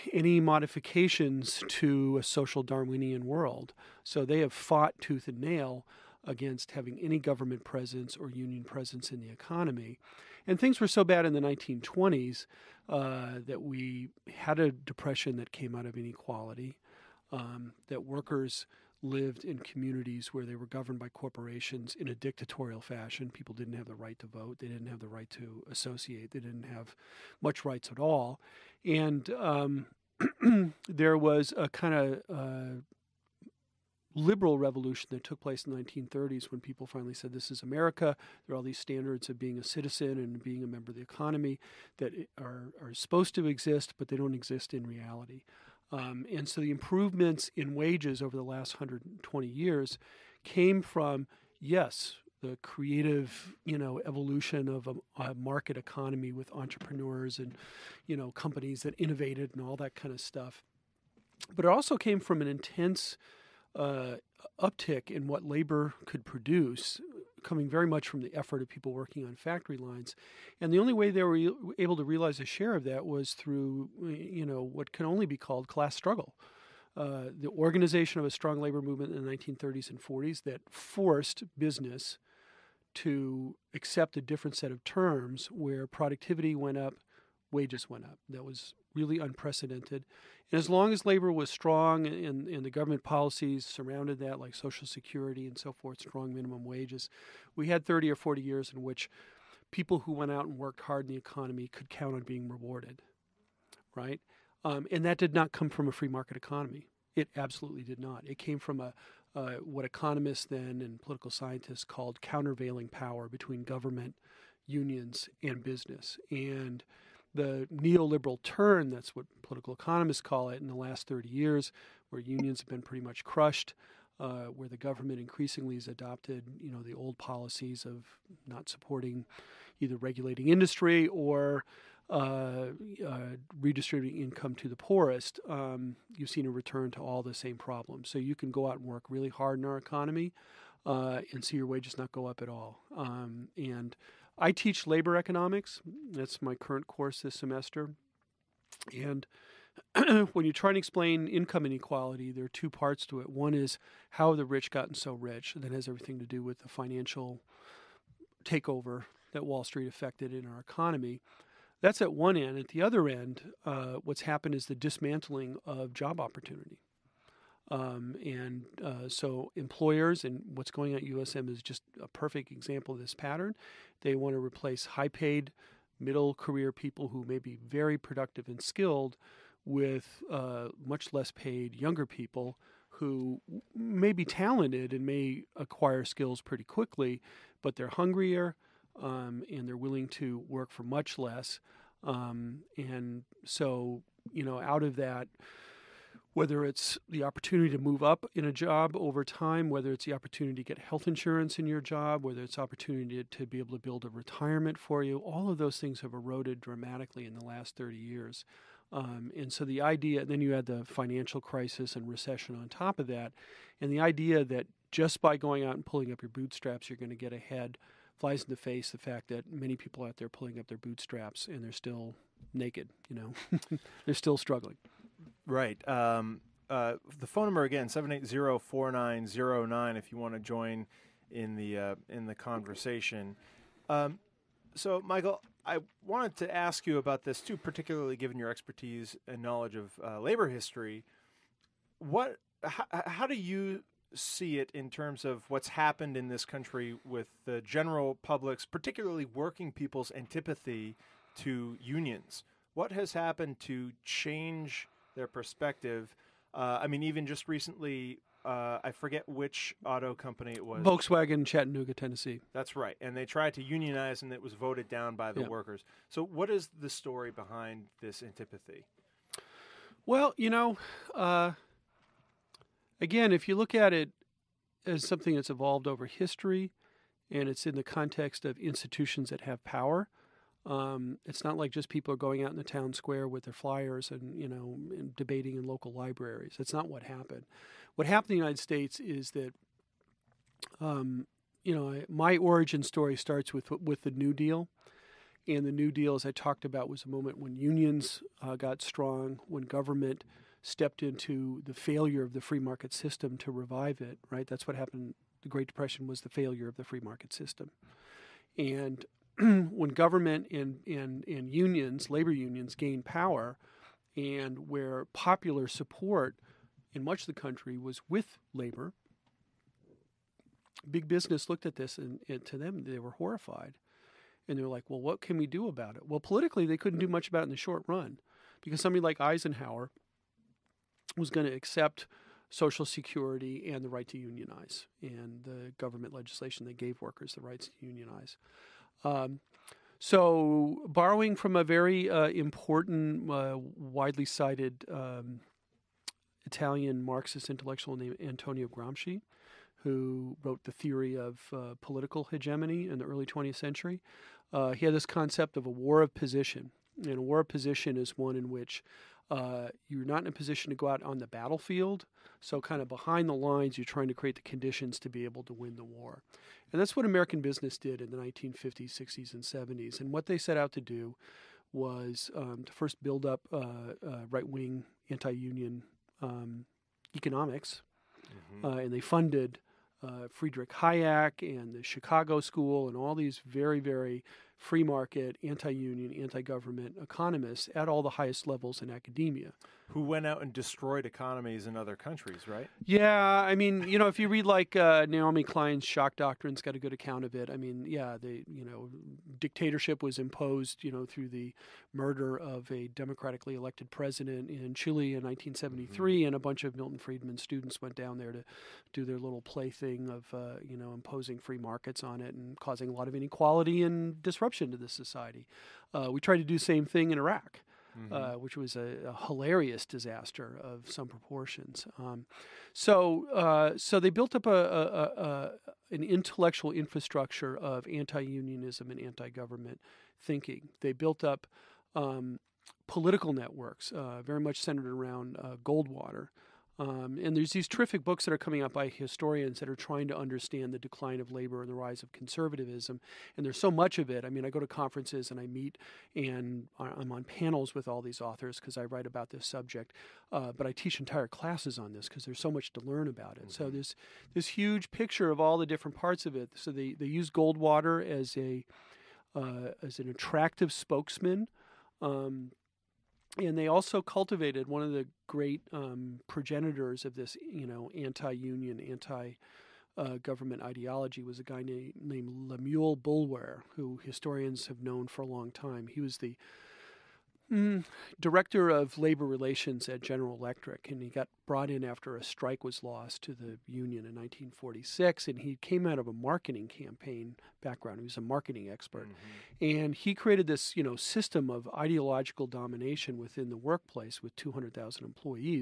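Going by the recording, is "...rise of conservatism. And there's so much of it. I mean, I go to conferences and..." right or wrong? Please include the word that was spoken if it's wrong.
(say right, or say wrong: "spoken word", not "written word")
right.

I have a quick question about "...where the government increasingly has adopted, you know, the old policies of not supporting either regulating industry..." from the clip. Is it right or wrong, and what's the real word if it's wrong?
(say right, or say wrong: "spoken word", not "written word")
right.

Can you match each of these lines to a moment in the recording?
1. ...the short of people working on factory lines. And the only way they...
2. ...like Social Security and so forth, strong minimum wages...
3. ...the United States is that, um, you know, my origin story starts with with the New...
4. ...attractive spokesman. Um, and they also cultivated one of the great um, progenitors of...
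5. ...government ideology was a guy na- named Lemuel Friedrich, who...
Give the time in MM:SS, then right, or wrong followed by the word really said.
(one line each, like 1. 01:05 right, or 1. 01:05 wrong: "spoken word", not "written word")
1. 01:08 wrong: "effort", not "short"
2. 01:34 right
3. 04:48 right
4. 07:40 right
5. 07:50 wrong: "Boulware", not "Friedrich".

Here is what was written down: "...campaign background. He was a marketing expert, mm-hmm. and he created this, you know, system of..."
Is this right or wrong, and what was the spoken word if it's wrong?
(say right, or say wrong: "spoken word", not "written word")
right.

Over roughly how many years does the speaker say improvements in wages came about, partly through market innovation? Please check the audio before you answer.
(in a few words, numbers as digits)
120.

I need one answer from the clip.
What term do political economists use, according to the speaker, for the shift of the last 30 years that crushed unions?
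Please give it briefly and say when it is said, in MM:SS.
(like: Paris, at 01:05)
neoliberal turn, at 01:57.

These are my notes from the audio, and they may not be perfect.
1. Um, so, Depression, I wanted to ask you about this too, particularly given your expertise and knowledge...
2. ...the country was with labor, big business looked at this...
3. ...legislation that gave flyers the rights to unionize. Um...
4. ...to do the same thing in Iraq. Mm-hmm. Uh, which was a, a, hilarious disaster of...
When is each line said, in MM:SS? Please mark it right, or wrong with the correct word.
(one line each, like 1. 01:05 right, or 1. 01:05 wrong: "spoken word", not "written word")
1. 03:53 wrong: "Michael", not "Depression"
2. 05:17 right
3. 05:36 wrong: "workers", not "flyers"
4. 06:56 right.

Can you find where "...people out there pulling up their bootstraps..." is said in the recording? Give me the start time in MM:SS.
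03:39.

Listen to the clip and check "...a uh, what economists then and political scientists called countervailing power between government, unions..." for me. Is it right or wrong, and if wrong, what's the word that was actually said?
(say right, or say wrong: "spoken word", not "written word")
right.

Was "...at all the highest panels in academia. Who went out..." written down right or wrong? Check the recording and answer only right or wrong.
wrong.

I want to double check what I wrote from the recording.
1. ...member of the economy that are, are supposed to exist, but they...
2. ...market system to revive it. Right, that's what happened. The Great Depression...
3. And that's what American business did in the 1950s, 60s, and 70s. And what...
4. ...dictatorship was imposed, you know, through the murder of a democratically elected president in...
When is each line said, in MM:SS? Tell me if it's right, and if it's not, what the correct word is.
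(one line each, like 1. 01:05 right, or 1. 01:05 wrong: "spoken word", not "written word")
1. 00:40 right
2. 05:02 right
3. 06:06 right
4. 06:39 right.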